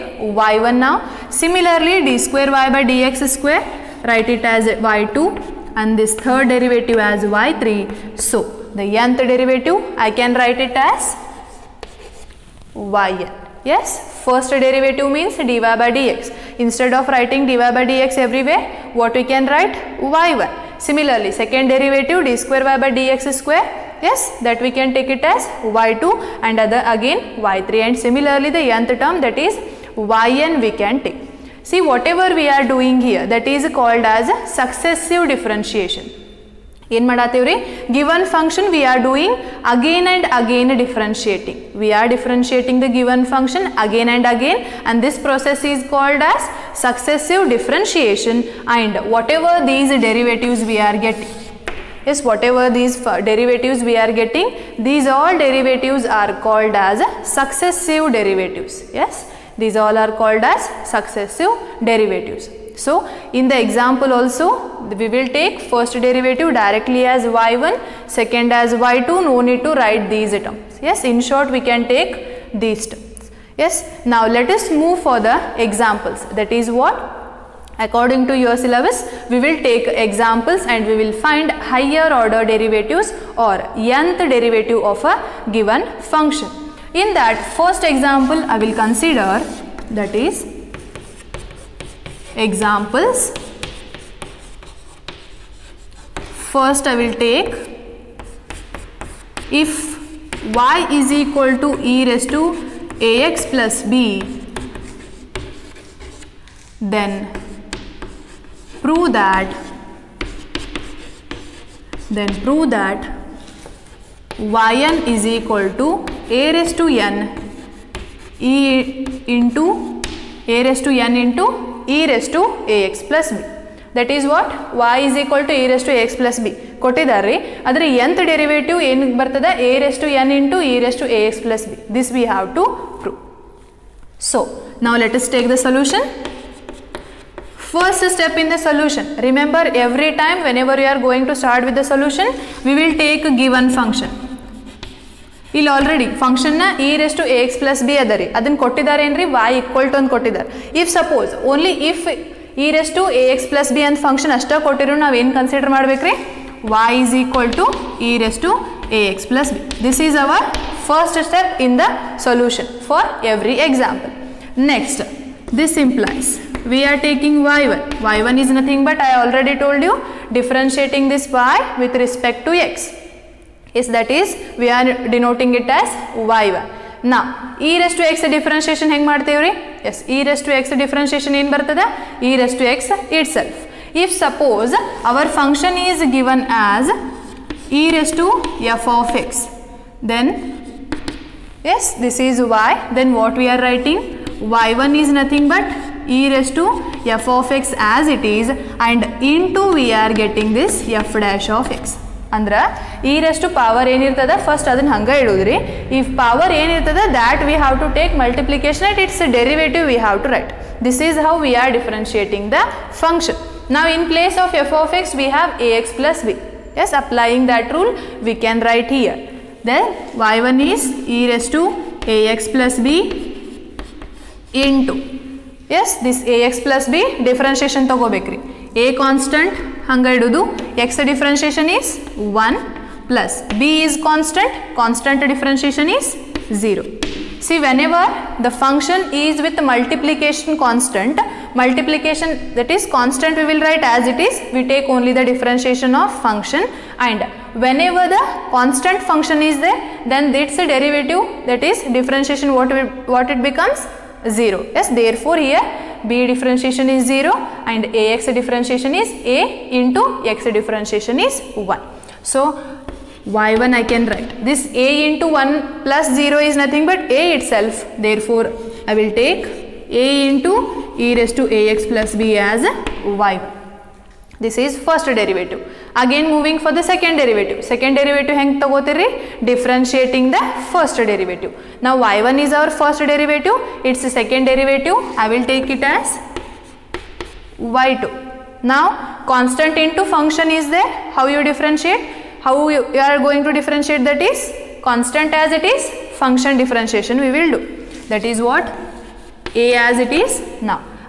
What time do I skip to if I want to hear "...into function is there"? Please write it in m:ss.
4:49.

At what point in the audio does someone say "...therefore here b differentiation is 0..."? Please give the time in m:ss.
4:14.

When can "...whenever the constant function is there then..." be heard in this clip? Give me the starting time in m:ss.
4:07.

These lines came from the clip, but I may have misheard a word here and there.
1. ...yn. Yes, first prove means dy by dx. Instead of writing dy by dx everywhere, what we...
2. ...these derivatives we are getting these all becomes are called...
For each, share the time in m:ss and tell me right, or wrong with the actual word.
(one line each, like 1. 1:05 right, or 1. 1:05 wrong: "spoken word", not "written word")
1. 0:12 wrong: "derivative", not "prove"
2. 0:52 wrong: "derivatives", not "becomes".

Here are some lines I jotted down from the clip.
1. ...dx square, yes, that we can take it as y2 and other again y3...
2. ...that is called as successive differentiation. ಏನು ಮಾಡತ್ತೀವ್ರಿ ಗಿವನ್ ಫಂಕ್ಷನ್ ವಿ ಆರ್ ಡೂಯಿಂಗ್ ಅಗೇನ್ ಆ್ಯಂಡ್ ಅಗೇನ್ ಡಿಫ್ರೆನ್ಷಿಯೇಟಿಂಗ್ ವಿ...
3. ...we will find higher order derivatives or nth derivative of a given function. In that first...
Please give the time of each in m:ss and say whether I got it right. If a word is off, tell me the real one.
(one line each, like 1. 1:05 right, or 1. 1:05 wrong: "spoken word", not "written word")
1. 0:22 right
2. 0:33 right
3. 1:20 right.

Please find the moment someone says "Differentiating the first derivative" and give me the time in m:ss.
4:39.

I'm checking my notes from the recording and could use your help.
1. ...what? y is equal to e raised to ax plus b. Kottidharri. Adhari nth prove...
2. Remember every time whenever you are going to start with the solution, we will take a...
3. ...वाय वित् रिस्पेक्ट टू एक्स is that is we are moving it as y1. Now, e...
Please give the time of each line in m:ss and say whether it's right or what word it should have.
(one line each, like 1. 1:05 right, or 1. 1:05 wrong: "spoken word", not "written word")
1. 2:04 wrong: "derivative", not "prove"
2. 2:19 right
3. 2:51 wrong: "denoting", not "moving".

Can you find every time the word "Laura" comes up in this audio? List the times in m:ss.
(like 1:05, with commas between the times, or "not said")
not said.